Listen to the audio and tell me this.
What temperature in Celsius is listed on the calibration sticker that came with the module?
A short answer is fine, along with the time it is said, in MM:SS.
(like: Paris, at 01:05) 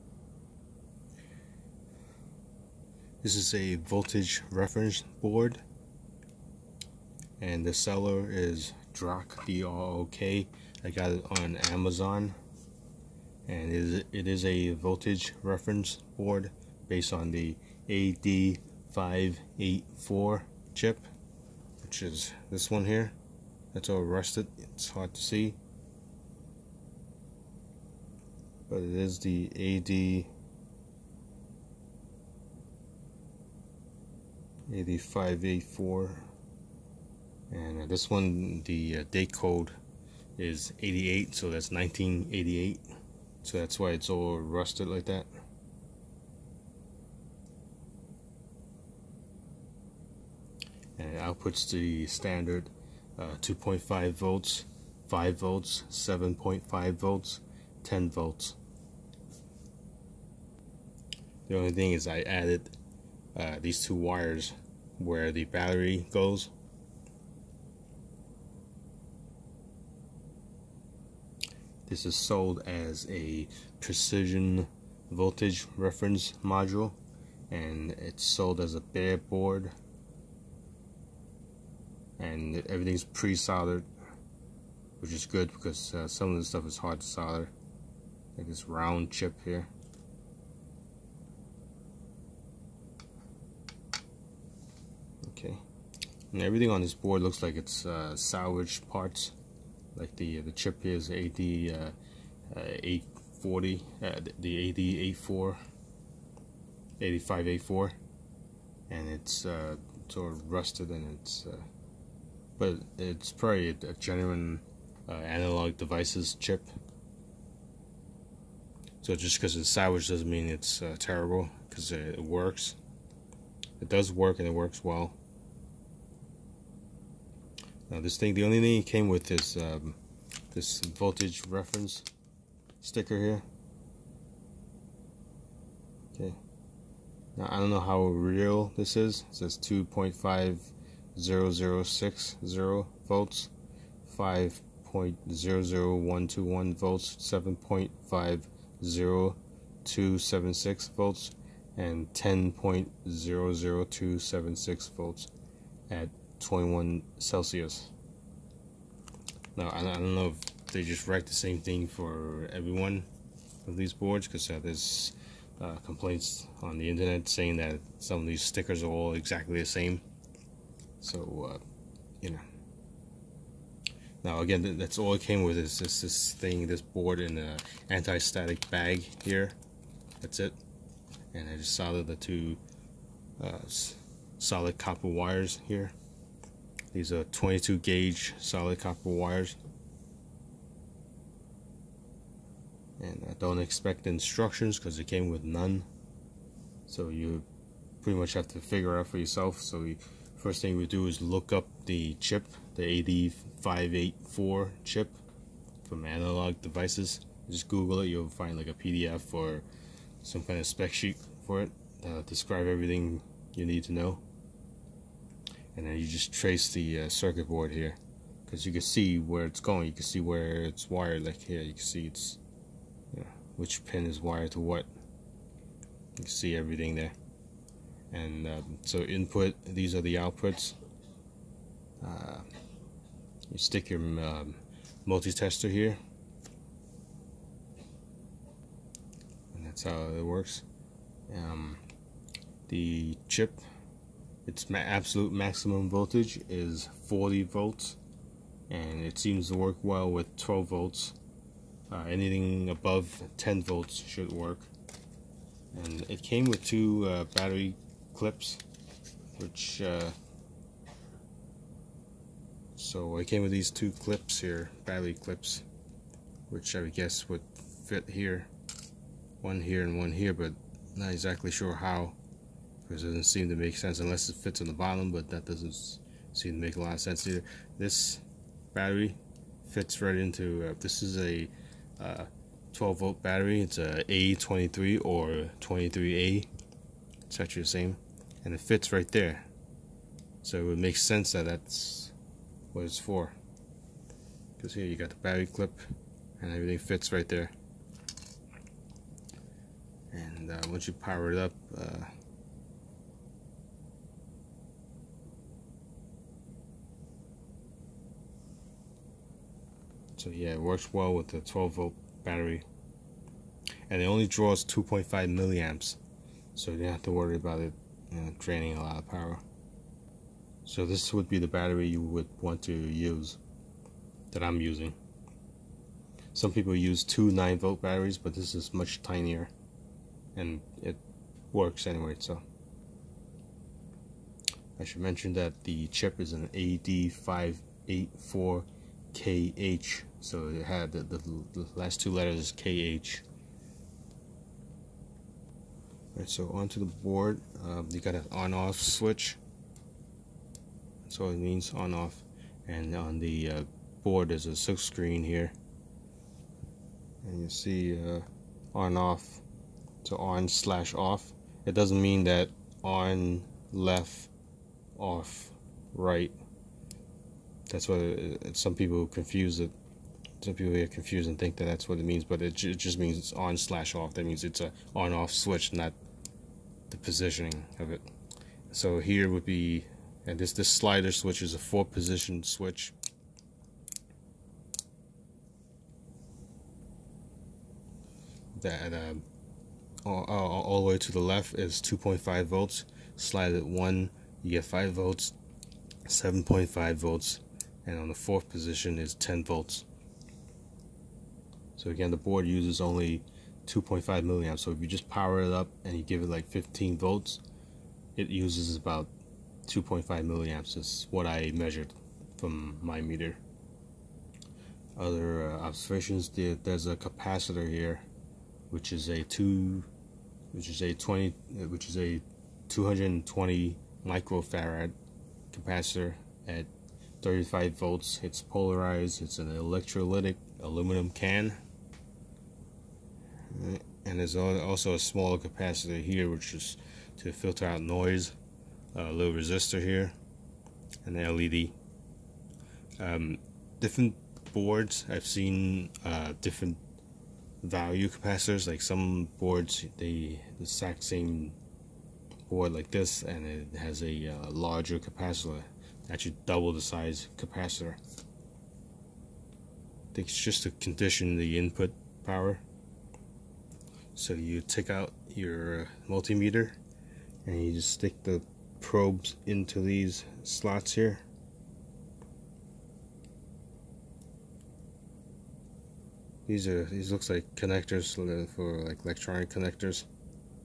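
21 Celsius, at 02:36.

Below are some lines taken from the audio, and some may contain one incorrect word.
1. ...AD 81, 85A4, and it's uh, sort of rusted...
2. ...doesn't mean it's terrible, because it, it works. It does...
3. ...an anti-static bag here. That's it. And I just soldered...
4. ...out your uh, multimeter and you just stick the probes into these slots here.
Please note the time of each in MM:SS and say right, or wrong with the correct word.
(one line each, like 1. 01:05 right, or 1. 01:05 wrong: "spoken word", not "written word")
1. 01:44 wrong: "84", not "81"
2. 02:00 right
3. 02:57 right
4. 07:44 right.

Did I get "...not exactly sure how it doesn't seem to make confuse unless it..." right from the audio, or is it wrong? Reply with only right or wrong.
wrong.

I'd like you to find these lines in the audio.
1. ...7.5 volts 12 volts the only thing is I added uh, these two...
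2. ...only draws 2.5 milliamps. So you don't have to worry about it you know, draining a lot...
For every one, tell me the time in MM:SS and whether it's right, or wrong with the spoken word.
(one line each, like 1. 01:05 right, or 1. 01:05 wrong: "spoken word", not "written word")
1. 00:55 wrong: "10", not "12"
2. 05:14 right.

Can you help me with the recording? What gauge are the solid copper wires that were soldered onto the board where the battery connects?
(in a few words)
22 gauge.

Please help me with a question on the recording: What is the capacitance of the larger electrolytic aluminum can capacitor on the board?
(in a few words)
220 microfarads.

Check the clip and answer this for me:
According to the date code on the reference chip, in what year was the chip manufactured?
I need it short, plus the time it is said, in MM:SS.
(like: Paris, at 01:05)
1988, at 00:41.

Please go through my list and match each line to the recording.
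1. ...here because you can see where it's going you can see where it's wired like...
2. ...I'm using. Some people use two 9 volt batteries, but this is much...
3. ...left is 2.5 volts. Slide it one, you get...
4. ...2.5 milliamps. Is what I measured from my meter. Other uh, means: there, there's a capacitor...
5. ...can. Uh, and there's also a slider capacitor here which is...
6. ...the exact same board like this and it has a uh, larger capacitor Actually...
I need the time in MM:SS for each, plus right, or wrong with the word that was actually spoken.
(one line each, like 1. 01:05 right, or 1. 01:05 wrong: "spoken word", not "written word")
1. 03:37 right
2. 05:24 right
3. 06:31 right
4. 06:49 wrong: "observations", not "means"
5. 07:11 wrong: "smaller", not "slider"
6. 07:30 right.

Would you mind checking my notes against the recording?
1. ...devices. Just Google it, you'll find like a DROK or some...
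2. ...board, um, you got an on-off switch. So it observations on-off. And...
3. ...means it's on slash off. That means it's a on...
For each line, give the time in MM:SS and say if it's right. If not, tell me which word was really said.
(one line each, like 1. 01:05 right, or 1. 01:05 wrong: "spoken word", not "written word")
1. 03:26 wrong: "PDF", not "DROK"
2. 05:46 wrong: "means", not "observations"
3. 06:12 right.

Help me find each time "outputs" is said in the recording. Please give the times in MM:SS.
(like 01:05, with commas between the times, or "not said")
00:51, 03:50.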